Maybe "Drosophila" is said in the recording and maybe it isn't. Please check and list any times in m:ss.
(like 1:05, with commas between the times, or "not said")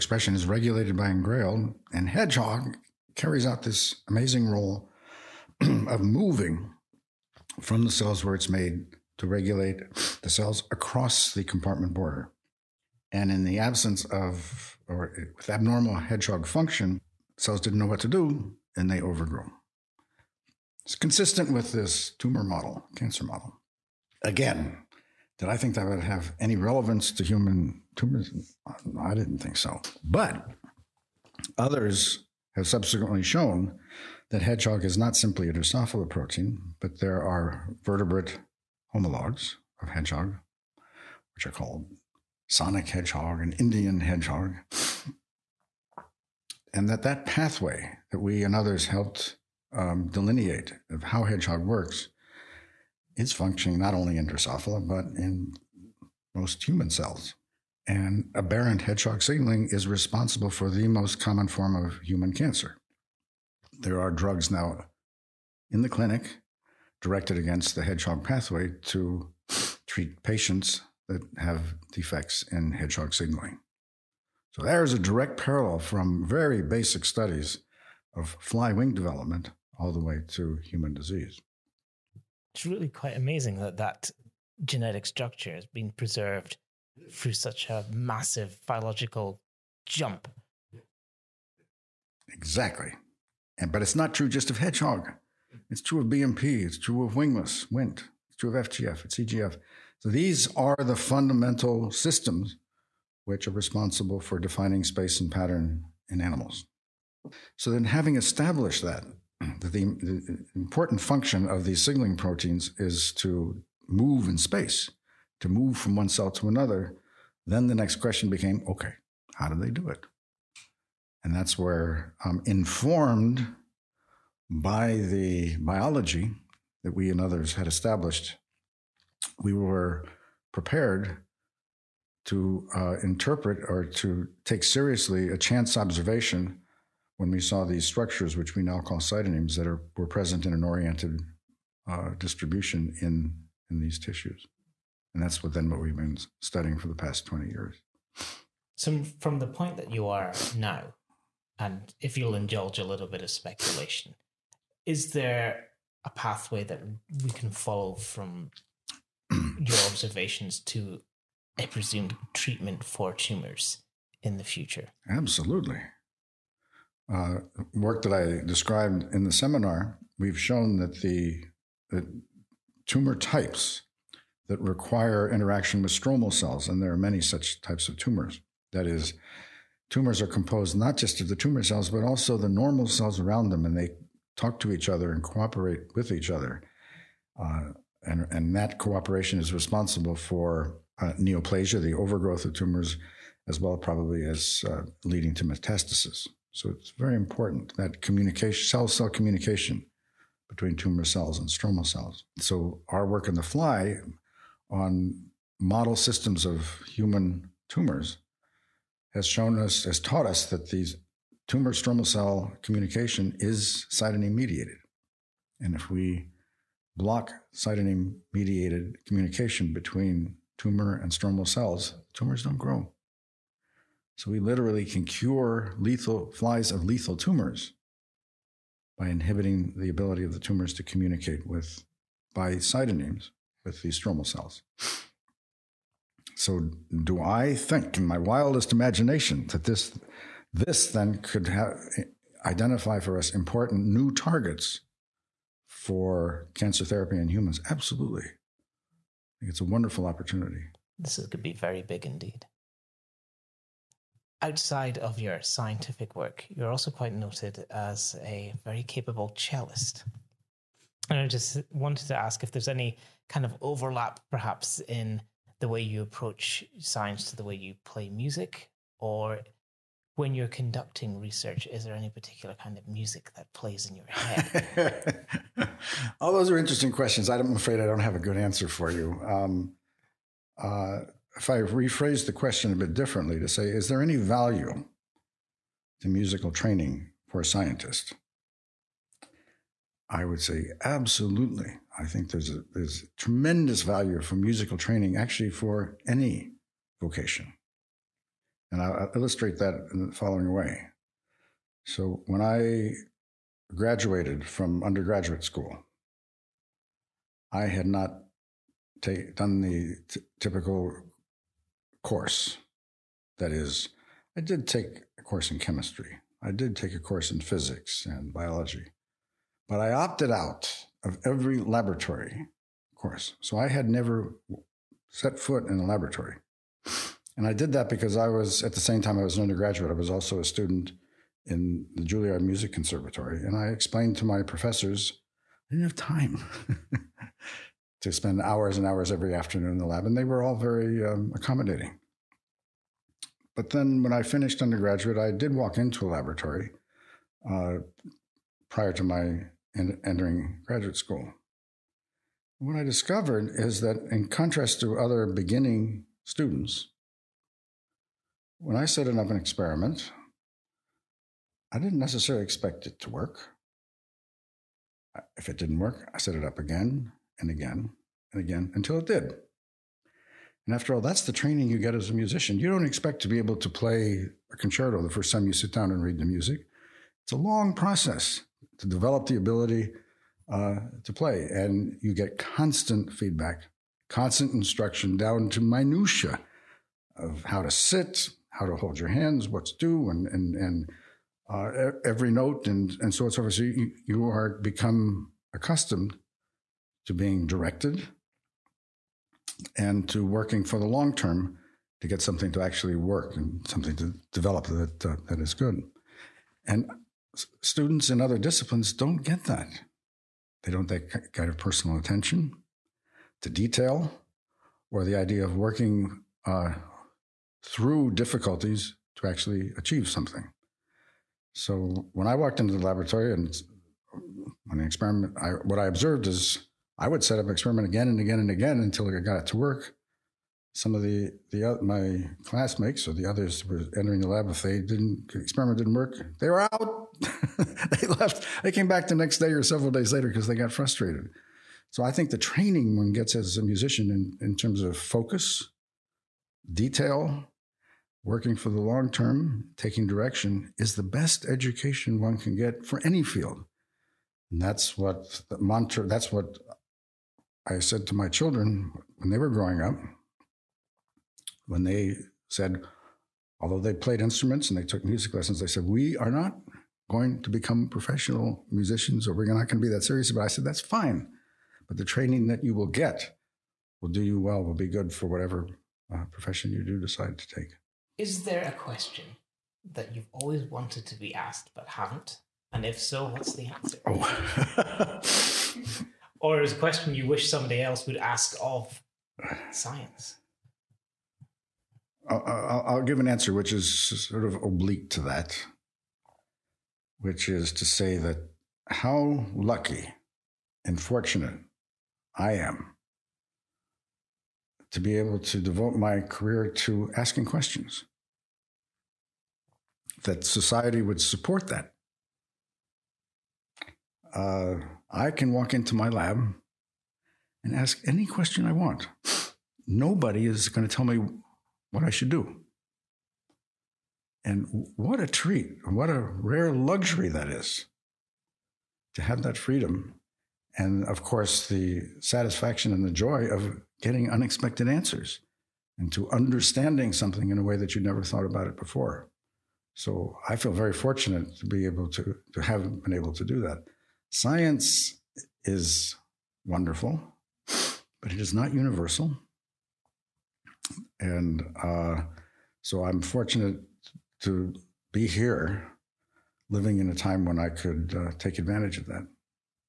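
0:35, 0:54.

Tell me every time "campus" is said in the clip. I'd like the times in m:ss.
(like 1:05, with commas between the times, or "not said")
not said.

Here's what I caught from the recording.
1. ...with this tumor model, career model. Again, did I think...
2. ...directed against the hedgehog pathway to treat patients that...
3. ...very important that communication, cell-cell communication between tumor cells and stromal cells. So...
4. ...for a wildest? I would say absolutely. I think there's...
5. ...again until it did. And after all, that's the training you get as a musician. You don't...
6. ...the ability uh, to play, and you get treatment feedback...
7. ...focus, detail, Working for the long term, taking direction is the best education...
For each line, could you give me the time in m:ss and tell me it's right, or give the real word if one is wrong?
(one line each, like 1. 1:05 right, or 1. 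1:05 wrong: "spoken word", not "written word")
1. 0:21 wrong: "cancer", not "career"
2. 1:06 right
3. 3:16 right
4. 4:47 wrong: "scientist", not "wildest"
5. 6:08 right
6. 6:19 wrong: "constant", not "treatment"
7. 7:24 right.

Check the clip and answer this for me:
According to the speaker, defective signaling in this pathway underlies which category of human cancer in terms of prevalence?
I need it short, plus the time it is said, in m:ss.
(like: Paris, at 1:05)
the most common form, at 1:00.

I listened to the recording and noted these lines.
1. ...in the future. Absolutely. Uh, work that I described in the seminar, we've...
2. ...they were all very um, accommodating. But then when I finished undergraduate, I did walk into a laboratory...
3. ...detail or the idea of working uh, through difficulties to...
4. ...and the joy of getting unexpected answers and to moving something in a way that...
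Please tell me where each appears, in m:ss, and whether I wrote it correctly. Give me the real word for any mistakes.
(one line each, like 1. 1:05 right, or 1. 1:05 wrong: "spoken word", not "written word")
1. 2:44 right
2. 5:40 right
3. 6:53 right
4. 8:52 wrong: "understanding", not "moving".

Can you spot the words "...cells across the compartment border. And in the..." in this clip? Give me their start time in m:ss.
0:10.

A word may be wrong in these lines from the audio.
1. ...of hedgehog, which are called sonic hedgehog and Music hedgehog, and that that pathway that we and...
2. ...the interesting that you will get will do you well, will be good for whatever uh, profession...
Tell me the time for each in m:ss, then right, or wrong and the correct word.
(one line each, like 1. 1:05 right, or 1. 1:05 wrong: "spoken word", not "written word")
1. 0:39 wrong: "Indian", not "Music"
2. 7:51 wrong: "training", not "interesting".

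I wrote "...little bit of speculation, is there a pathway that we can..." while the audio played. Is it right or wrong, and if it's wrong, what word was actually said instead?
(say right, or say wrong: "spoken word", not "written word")
right.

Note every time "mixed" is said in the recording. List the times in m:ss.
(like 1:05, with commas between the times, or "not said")
not said.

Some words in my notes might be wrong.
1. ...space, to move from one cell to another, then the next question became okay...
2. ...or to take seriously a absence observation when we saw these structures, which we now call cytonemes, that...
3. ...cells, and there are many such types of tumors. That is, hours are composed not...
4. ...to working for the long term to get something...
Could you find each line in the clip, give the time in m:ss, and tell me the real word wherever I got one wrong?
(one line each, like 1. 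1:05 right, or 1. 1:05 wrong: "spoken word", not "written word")
1. 1:54 right
2. 2:13 wrong: "chance", not "absence"
3. 2:56 wrong: "tumors", not "hours"
4. 6:40 right.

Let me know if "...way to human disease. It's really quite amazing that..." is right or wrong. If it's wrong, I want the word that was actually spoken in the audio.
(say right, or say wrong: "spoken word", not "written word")
right.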